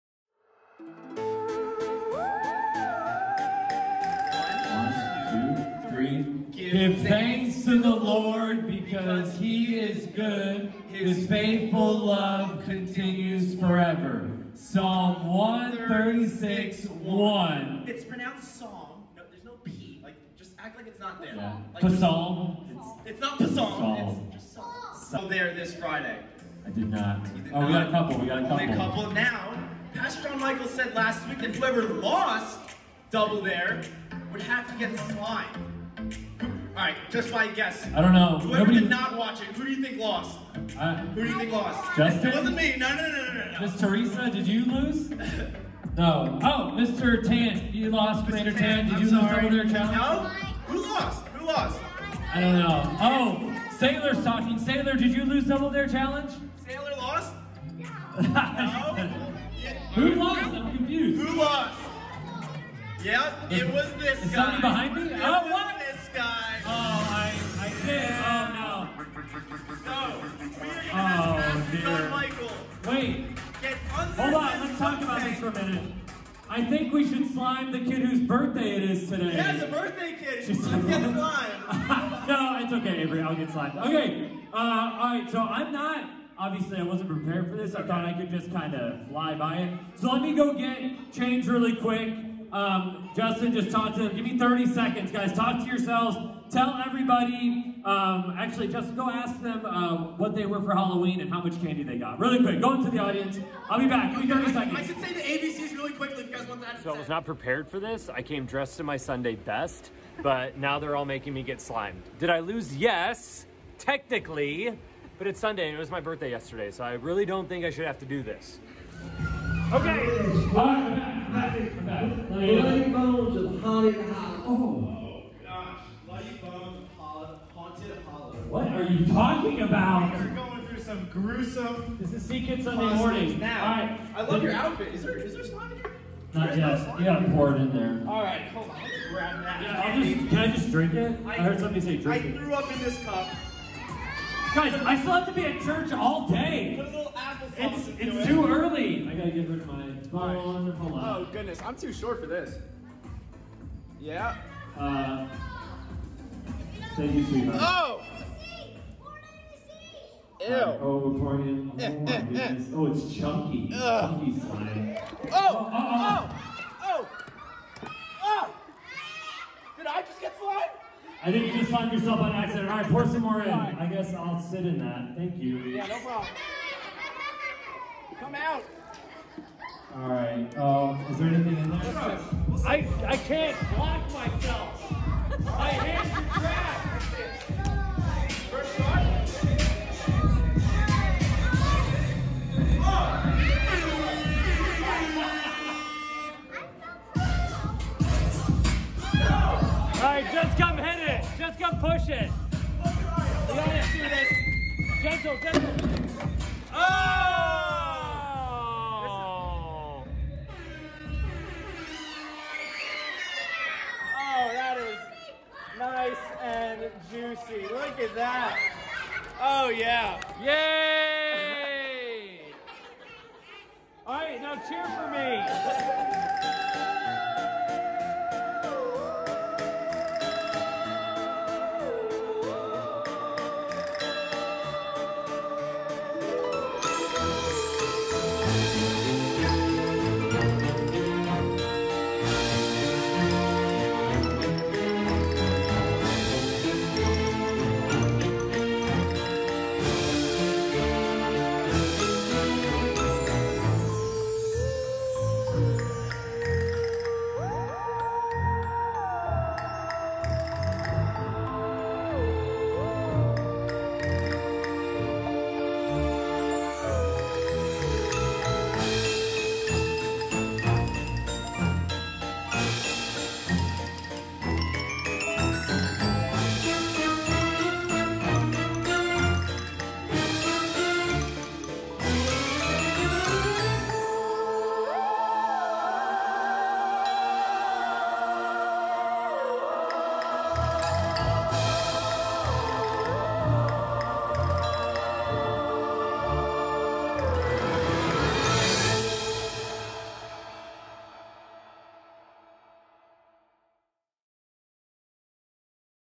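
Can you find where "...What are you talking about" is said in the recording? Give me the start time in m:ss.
2:06.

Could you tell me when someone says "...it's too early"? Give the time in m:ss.
2:27.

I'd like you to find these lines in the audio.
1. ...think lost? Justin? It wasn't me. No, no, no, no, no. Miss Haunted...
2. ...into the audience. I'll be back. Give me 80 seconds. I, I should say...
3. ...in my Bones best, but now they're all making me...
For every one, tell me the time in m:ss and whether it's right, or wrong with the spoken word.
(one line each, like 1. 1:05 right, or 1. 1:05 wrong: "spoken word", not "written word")
1. 0:41 wrong: "Teresa", not "Haunted"
2. 1:42 wrong: "30", not "80"
3. 1:48 wrong: "Sunday", not "Bones".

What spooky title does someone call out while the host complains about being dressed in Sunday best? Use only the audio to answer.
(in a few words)
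Bloody Bones of Haunted Hollow.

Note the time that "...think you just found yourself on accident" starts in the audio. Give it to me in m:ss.
2:51.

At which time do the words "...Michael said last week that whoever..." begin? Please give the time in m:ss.
0:30.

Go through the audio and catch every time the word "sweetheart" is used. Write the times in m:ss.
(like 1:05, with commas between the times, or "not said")
2:37.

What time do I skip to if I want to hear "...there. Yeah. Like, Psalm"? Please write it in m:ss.
0:21.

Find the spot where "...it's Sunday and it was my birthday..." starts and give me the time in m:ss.
1:55.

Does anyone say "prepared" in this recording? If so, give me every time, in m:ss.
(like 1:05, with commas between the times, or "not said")
1:27, 1:47.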